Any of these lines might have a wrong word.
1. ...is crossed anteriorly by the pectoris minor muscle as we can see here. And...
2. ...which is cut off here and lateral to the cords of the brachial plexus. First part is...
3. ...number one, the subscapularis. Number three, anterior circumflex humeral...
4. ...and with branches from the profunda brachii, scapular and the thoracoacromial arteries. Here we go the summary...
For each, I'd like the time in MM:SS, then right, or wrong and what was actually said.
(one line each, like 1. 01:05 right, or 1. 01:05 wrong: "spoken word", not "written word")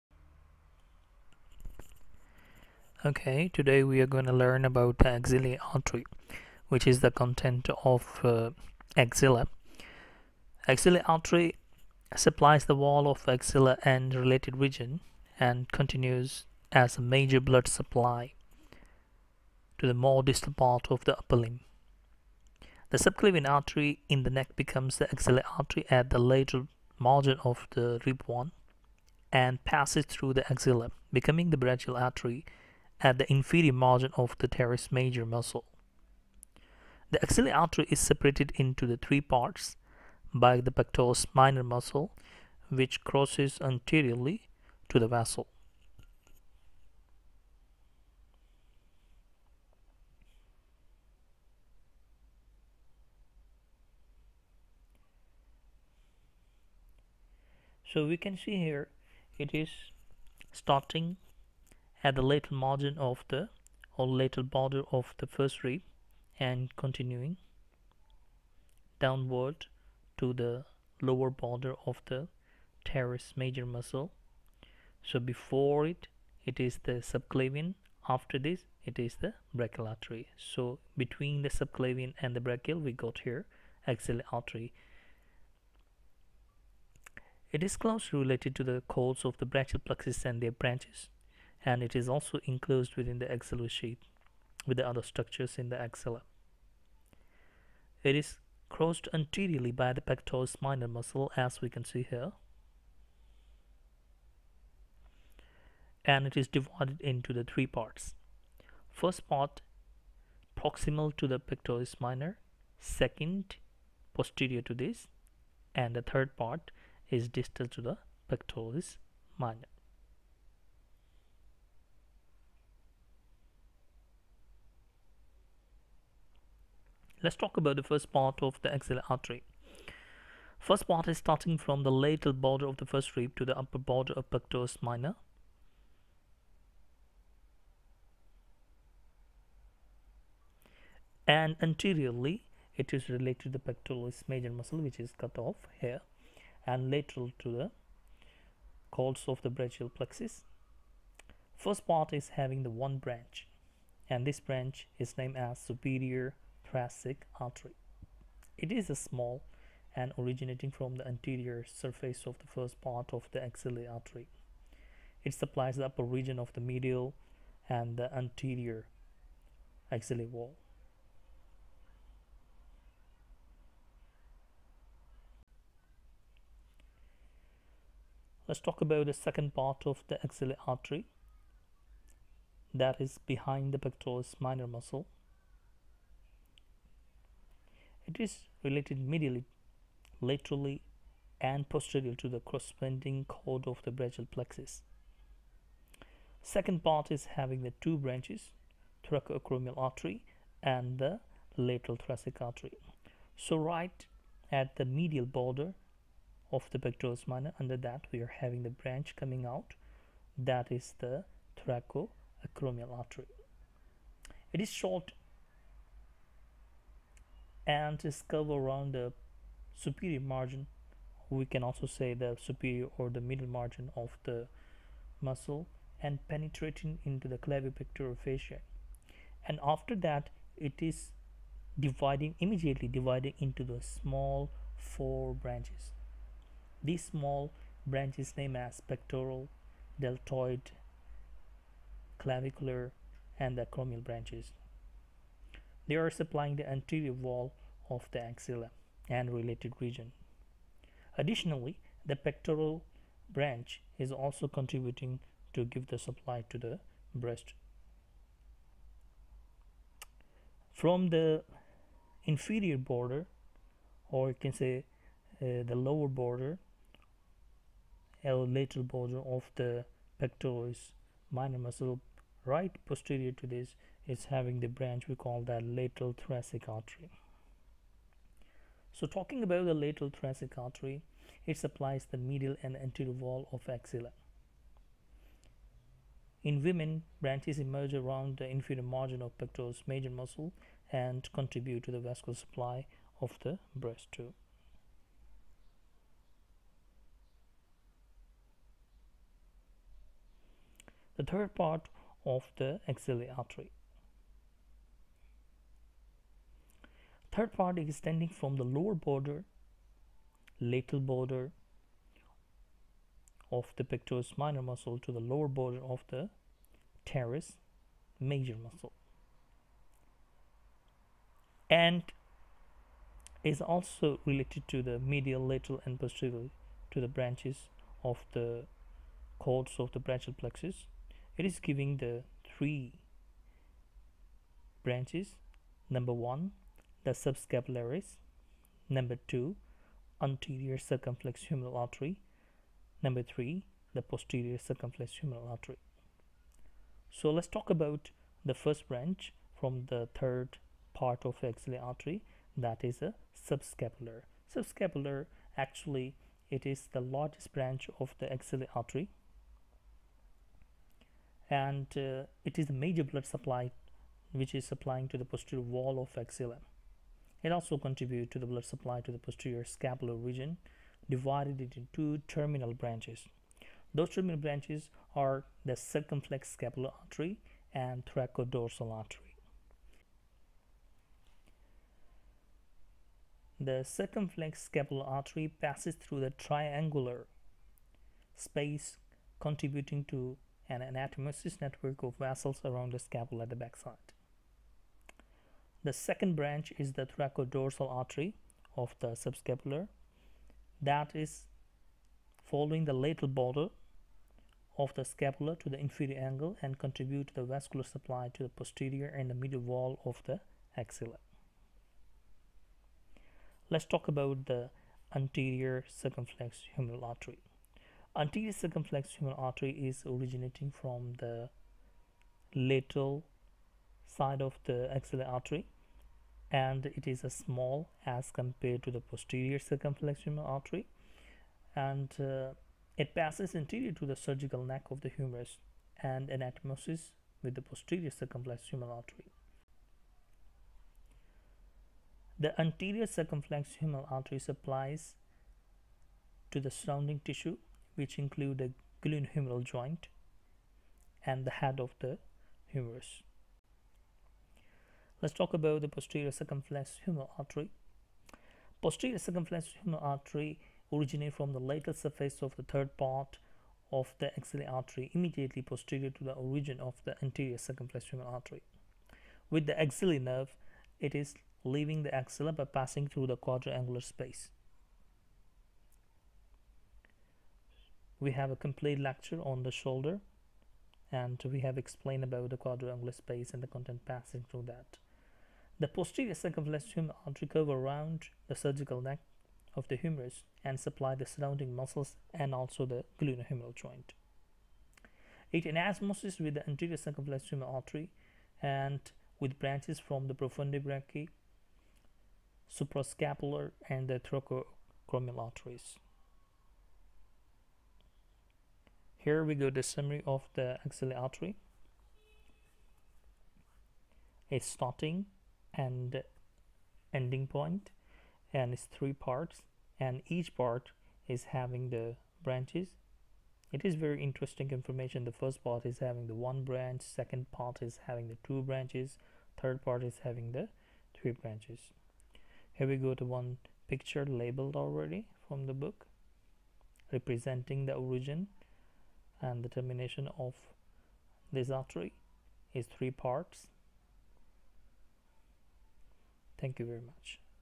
1. 01:38 right
2. 02:24 right
3. 05:35 wrong: "two", not "three"
4. 08:18 wrong: "suprascapular", not "scapular".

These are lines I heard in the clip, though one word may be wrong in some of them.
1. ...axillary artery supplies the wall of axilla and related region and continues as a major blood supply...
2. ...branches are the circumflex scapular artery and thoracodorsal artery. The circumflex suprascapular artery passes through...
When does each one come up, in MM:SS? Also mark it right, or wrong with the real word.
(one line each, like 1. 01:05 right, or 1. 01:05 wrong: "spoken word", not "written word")
1. 00:10 right
2. 06:14 wrong: "scapular", not "suprascapular".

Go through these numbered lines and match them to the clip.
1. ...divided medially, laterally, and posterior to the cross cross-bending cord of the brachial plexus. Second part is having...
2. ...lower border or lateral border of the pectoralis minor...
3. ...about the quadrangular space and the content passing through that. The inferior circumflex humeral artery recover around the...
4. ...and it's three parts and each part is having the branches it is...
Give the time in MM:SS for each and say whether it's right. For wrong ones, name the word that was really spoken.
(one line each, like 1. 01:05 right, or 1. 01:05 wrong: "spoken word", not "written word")
1. 03:08 wrong: "related", not "divided"
2. 04:25 right
3. 08:02 wrong: "posterior", not "inferior"
4. 08:38 right.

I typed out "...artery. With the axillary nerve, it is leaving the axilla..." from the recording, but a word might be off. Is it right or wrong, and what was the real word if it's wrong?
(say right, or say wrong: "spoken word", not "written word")
right.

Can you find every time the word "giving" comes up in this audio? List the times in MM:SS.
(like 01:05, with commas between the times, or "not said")
05:31.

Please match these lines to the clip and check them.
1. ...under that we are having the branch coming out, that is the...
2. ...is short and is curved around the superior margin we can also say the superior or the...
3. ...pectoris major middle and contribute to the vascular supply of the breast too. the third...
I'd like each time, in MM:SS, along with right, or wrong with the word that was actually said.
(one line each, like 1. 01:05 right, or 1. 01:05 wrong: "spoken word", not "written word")
1. 03:27 right
2. 03:34 right
3. 04:49 wrong: "muscle", not "middle".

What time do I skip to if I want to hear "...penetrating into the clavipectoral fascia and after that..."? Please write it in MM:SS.
03:46.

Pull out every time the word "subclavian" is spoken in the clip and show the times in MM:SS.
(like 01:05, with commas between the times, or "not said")
00:22, 01:17, 01:21.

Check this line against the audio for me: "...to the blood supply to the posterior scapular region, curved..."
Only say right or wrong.
wrong.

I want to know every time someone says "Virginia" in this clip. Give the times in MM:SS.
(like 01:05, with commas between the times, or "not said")
not said.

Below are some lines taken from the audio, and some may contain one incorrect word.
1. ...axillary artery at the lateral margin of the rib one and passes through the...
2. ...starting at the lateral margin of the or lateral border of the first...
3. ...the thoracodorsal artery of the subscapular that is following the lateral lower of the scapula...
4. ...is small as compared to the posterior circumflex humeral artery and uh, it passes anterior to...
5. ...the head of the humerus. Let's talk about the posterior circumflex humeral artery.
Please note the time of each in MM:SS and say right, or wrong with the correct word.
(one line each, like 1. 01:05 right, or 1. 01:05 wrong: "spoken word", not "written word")
1. 00:25 right
2. 01:00 right
3. 06:36 wrong: "border", not "lower"
4. 07:07 right
5. 07:31 right.